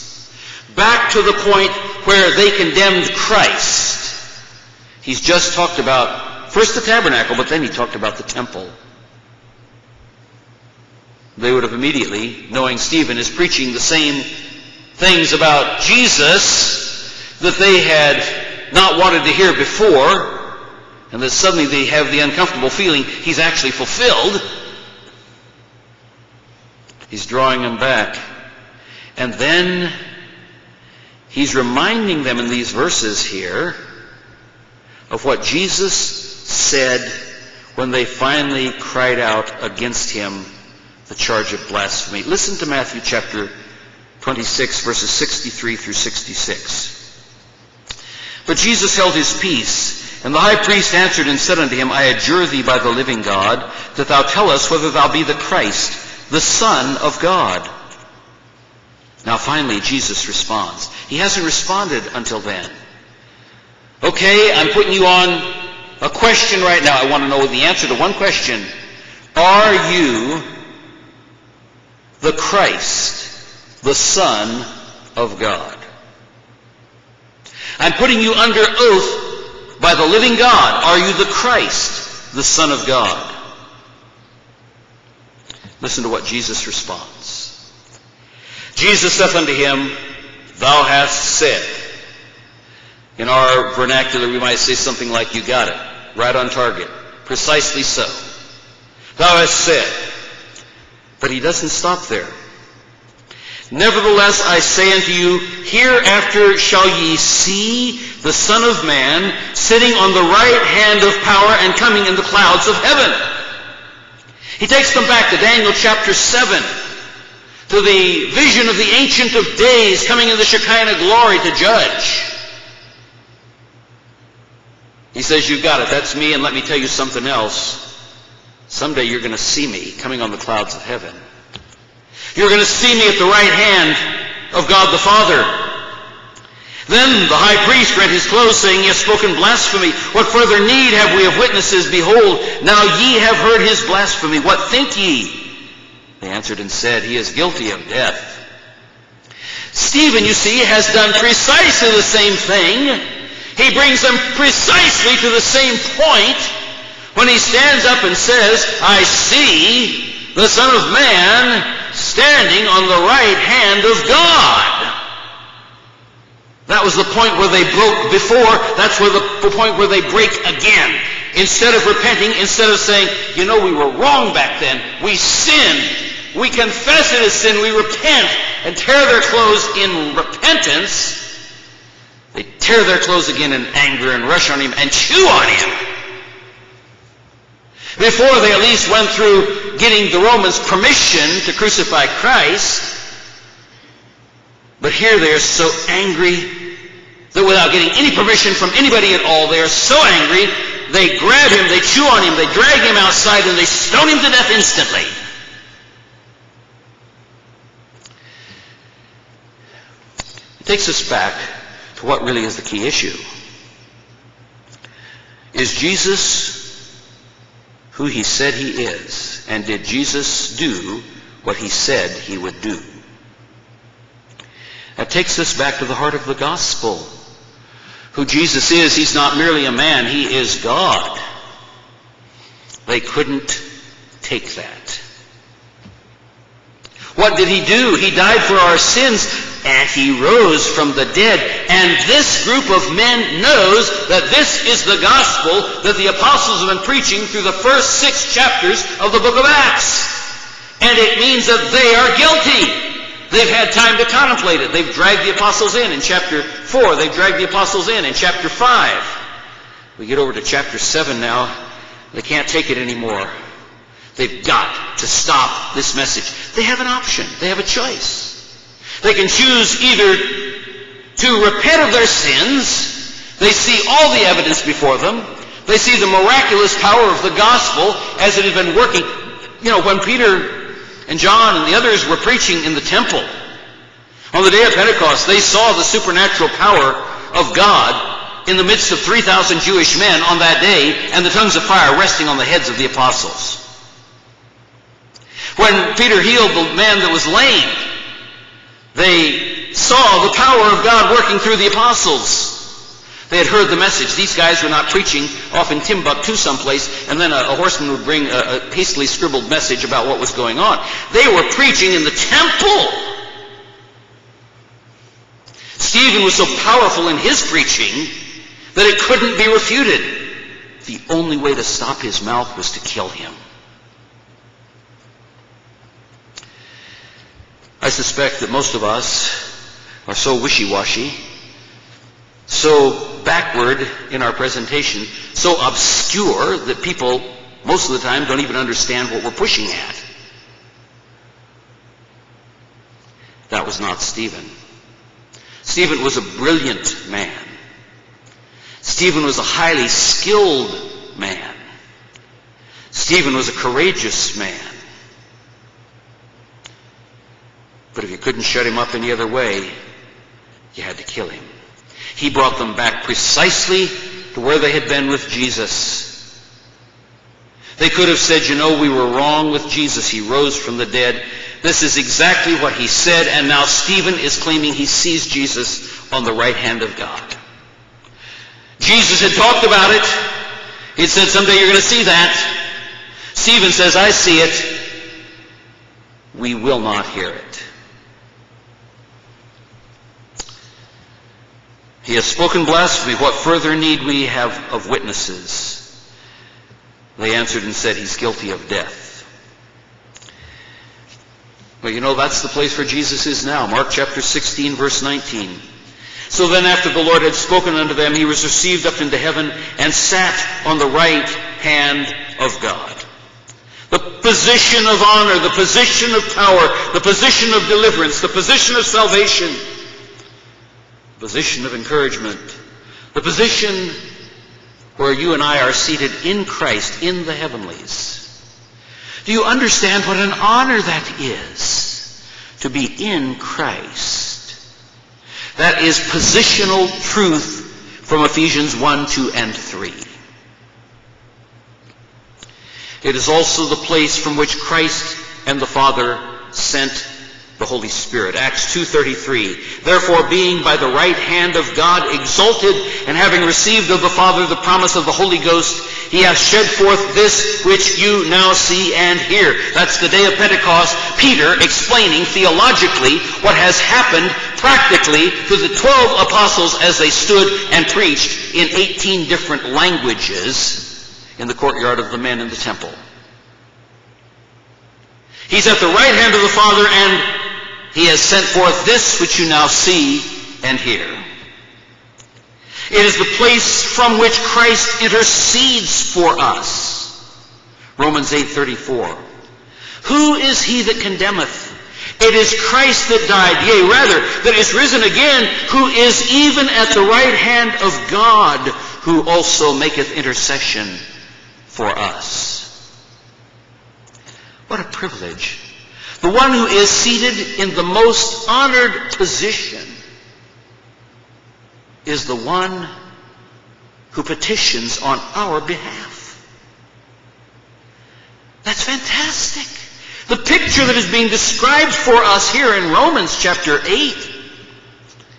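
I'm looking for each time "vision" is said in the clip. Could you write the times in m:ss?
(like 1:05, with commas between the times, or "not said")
1:58.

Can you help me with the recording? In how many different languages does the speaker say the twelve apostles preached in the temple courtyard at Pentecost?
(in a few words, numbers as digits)
18.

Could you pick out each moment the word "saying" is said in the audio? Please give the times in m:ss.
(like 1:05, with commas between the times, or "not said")
2:18, 2:52.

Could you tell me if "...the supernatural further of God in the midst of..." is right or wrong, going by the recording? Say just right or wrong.
wrong.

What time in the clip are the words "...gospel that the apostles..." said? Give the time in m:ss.
4:05.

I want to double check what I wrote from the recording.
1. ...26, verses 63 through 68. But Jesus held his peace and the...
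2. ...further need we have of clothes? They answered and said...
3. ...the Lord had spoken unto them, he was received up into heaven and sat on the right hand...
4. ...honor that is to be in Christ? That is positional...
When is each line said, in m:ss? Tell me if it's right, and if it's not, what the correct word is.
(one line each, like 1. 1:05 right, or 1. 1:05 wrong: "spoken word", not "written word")
1. 0:44 wrong: "66", not "68"
2. 6:33 wrong: "witnesses", not "clothes"
3. 6:46 right
4. 7:10 right.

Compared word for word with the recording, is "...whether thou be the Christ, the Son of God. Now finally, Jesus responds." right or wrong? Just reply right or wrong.
right.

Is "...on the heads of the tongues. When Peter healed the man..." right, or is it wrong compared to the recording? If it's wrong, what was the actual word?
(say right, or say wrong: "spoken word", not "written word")
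wrong: "apostles", not "tongues".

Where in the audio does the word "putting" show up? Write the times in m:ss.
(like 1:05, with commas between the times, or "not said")
1:04, 1:17.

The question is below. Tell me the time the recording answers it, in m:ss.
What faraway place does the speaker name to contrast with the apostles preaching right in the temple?
5:05.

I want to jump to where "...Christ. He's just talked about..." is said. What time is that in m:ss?
0:03.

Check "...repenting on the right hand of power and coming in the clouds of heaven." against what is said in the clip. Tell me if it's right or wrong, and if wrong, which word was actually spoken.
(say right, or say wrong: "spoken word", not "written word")
wrong: "sitting", not "repenting".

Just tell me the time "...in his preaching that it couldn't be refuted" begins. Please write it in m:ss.
5:17.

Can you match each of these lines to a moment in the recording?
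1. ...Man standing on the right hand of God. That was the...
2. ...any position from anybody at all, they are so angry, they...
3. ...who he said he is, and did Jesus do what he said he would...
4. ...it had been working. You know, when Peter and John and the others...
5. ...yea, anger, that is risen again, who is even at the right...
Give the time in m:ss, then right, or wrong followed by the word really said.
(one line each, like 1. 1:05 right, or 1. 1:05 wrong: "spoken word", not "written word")
1. 2:40 right
2. 3:17 wrong: "permission", not "position"
3. 3:37 right
4. 4:38 right
5. 8:13 wrong: "rather", not "anger".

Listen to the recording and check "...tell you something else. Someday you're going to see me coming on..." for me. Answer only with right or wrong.
right.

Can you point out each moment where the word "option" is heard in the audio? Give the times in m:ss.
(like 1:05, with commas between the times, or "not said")
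4:26.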